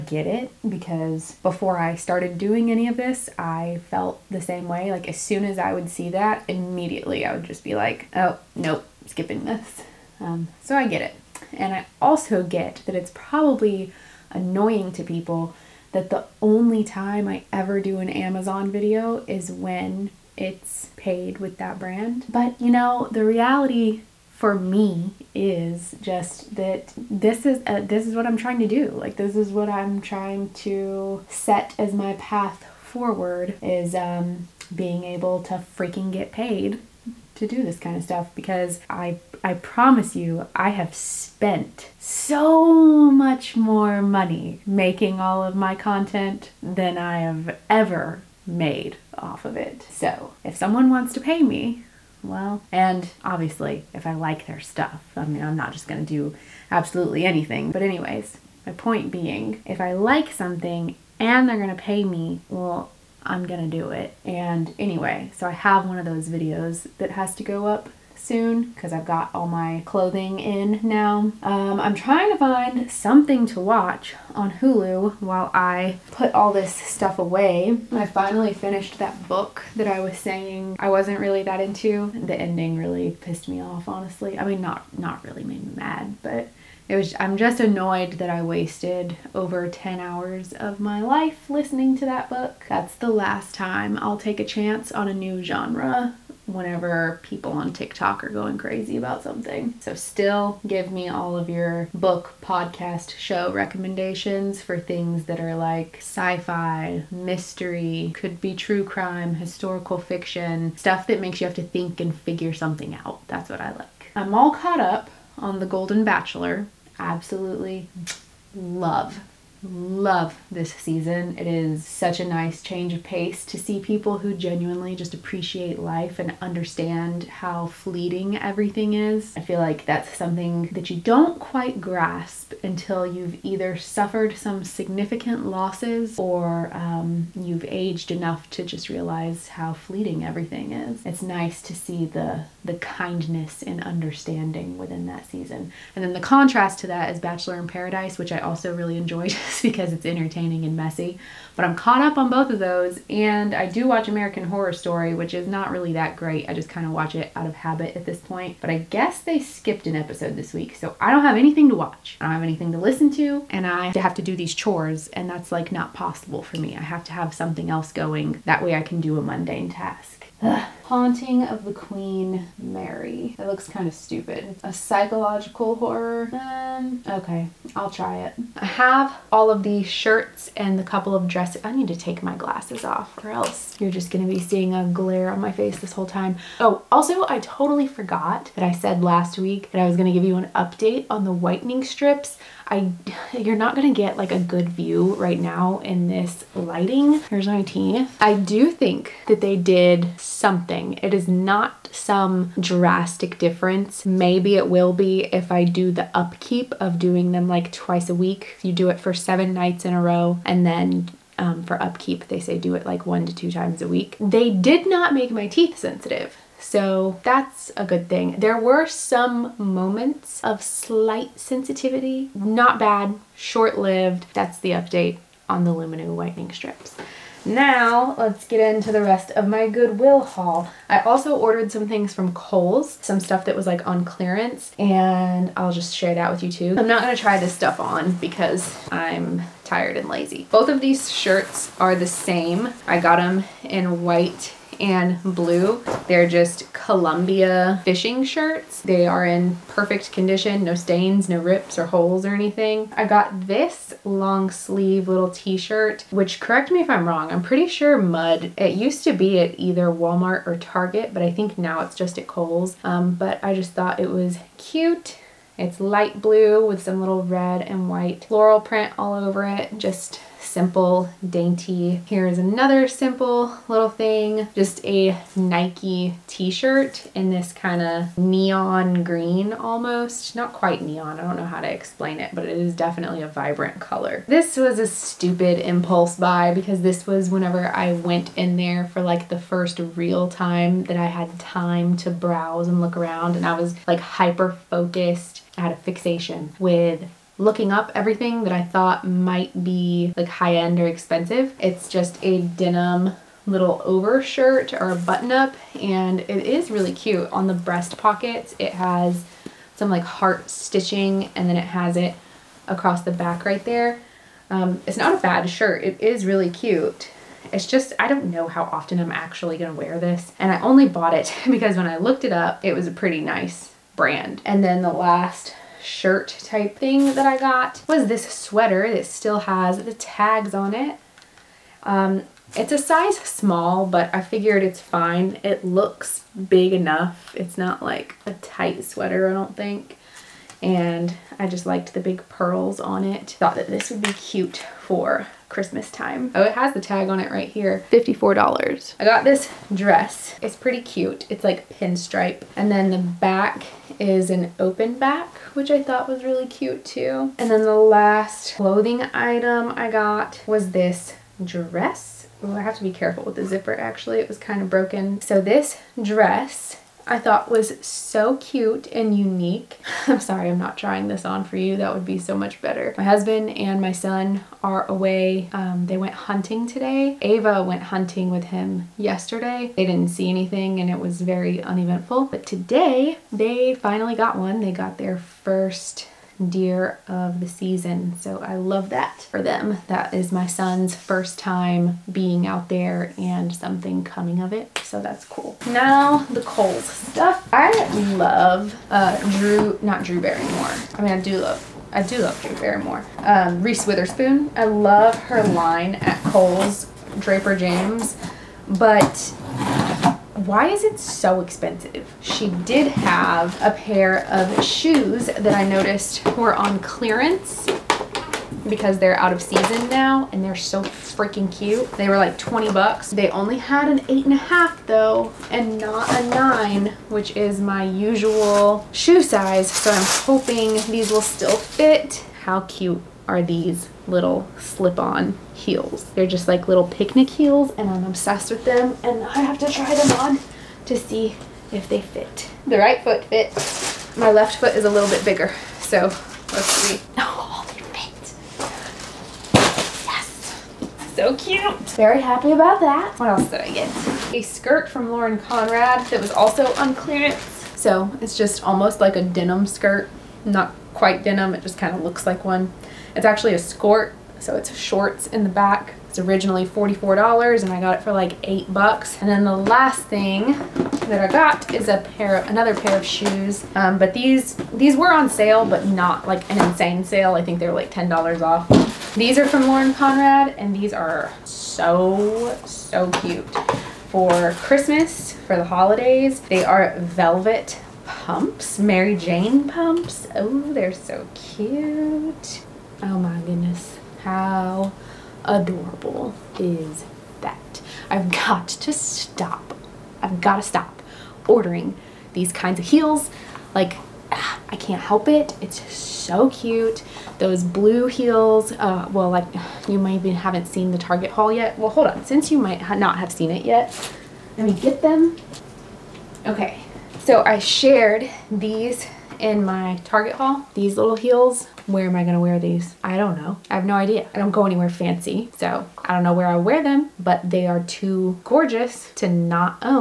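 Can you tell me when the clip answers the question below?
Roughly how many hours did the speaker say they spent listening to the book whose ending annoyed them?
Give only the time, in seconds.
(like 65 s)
89 s.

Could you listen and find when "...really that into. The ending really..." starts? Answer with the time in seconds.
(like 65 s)
81 s.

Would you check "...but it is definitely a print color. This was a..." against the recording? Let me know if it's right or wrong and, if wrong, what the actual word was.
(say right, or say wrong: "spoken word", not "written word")
wrong: "vibrant", not "print".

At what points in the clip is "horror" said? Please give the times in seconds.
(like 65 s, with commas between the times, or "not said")
154 s, 175 s.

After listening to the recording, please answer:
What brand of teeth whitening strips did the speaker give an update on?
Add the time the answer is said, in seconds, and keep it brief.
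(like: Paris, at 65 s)
Lumineux, at 225 s.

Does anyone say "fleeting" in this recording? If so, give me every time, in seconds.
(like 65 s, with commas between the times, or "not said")
127 s, 139 s.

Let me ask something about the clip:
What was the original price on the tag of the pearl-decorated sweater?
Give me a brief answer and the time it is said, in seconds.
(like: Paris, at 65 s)
$54, at 347 s.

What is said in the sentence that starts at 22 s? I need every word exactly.
But you know, the reality for me is just that this is a, uh, this is what I'm trying to do.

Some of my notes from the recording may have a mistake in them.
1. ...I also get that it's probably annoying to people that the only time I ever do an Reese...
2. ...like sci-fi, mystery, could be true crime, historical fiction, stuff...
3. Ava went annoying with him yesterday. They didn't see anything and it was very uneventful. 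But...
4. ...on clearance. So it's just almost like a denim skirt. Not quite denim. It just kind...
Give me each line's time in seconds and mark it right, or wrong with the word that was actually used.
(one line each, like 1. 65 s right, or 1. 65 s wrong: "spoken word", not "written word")
1. 11 s wrong: "Amazon", not "Reese"
2. 105 s right
3. 377 s wrong: "hunting", not "annoying"
4. 456 s right.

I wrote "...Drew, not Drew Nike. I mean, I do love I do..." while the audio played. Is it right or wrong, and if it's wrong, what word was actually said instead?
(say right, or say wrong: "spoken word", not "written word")
wrong: "Barrymore", not "Nike".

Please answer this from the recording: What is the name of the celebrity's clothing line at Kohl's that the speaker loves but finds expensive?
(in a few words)
Draper James.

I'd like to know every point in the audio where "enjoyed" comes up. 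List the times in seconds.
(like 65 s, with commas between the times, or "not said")
148 s.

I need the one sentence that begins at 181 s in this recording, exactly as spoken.
I need to take my glasses off or else you're just gonna be seeing a glare on my face this whole time.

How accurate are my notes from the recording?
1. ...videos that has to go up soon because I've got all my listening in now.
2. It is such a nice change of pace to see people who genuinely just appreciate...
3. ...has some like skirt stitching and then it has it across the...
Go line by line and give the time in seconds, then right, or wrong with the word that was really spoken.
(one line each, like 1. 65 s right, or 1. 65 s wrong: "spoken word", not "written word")
1. 66 s wrong: "clothing", not "listening"
2. 121 s right
3. 308 s wrong: "heart", not "skirt".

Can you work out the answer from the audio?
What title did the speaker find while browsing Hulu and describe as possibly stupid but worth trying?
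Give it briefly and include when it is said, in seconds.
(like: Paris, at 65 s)
Haunting of the Queen Mary, at 170 s.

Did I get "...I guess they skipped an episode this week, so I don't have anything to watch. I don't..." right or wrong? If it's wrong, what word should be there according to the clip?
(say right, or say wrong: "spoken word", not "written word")
right.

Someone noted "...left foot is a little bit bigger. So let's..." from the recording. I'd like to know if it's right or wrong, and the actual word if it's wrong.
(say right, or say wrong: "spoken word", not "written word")
right.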